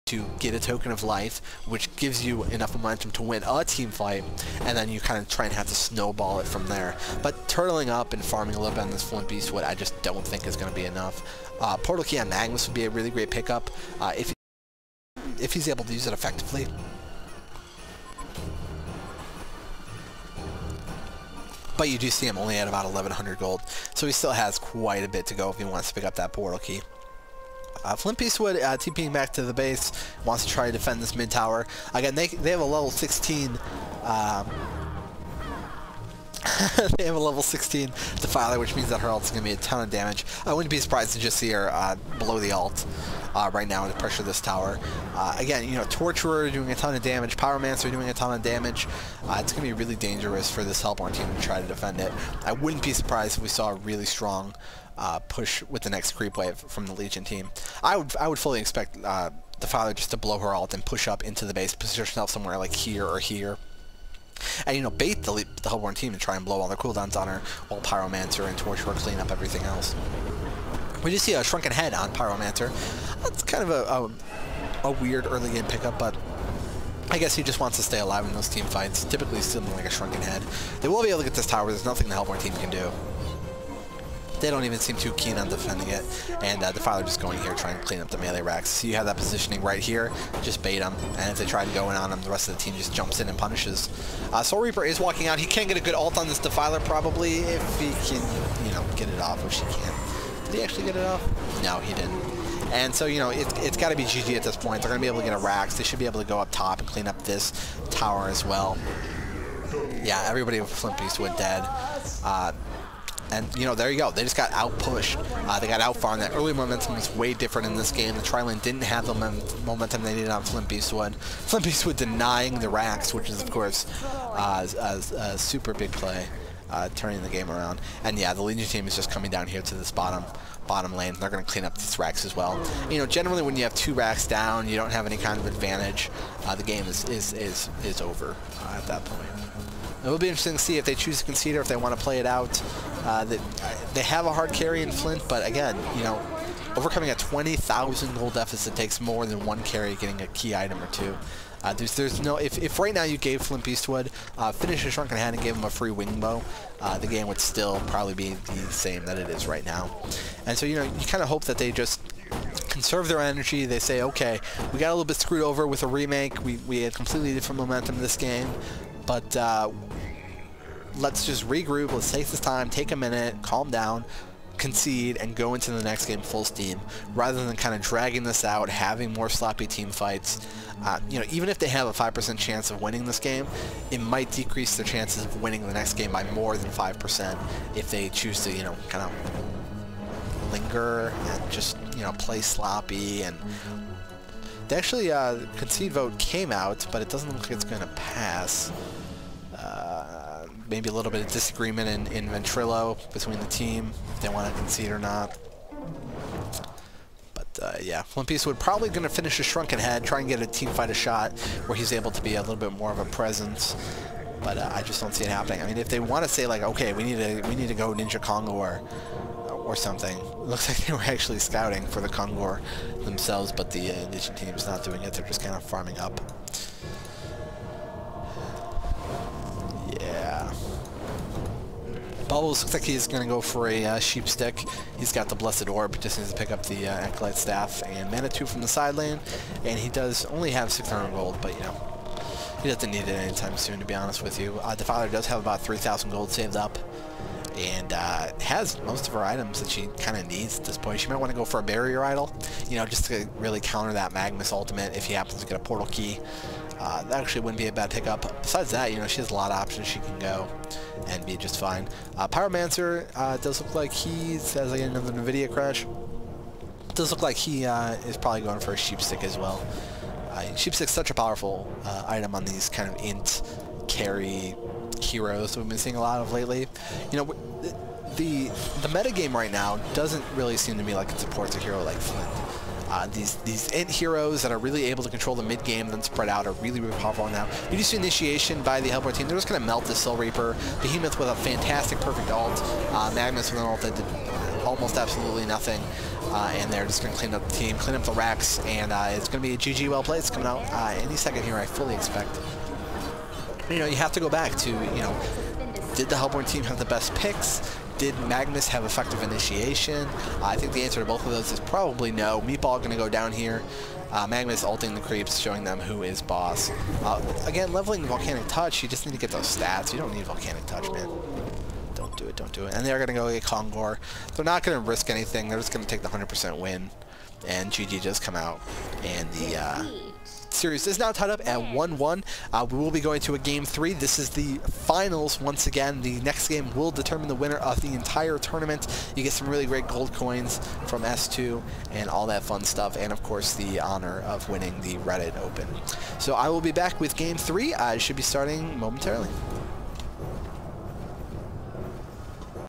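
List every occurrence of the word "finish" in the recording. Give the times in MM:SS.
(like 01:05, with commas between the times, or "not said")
02:34, 03:29.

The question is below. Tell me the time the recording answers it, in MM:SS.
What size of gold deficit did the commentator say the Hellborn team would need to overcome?
02:27.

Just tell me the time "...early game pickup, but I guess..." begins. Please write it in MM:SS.
01:15.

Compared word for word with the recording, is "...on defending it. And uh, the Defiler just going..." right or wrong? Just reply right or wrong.
right.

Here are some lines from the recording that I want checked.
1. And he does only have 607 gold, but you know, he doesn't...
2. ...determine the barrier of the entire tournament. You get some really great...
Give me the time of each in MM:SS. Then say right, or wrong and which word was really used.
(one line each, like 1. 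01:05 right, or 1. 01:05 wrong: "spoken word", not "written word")
1. 03:59 wrong: "600", not "607"
2. 05:36 wrong: "winner", not "barrier".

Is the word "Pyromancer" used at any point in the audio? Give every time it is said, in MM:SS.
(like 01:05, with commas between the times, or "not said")
00:47, 01:07, 01:12, 04:22.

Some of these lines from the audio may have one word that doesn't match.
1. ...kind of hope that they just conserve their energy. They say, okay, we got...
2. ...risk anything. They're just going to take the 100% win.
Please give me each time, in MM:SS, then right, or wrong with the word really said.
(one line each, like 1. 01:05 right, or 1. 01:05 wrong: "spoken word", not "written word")
1. 02:41 right
2. 05:24 right.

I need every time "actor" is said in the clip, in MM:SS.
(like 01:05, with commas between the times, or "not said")
not said.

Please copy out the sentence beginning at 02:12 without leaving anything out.
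You know, generally when you have two racks down, you don't have any kind of advantage.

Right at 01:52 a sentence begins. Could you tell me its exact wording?
Uh, and, you know, there you go.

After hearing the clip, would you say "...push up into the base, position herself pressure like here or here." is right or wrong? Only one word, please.
wrong.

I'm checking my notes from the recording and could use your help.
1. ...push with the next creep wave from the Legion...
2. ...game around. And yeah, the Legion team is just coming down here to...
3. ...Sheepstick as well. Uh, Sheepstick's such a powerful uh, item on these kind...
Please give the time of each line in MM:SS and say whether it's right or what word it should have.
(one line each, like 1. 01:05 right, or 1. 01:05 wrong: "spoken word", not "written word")
1. 00:55 right
2. 02:07 right
3. 04:28 right.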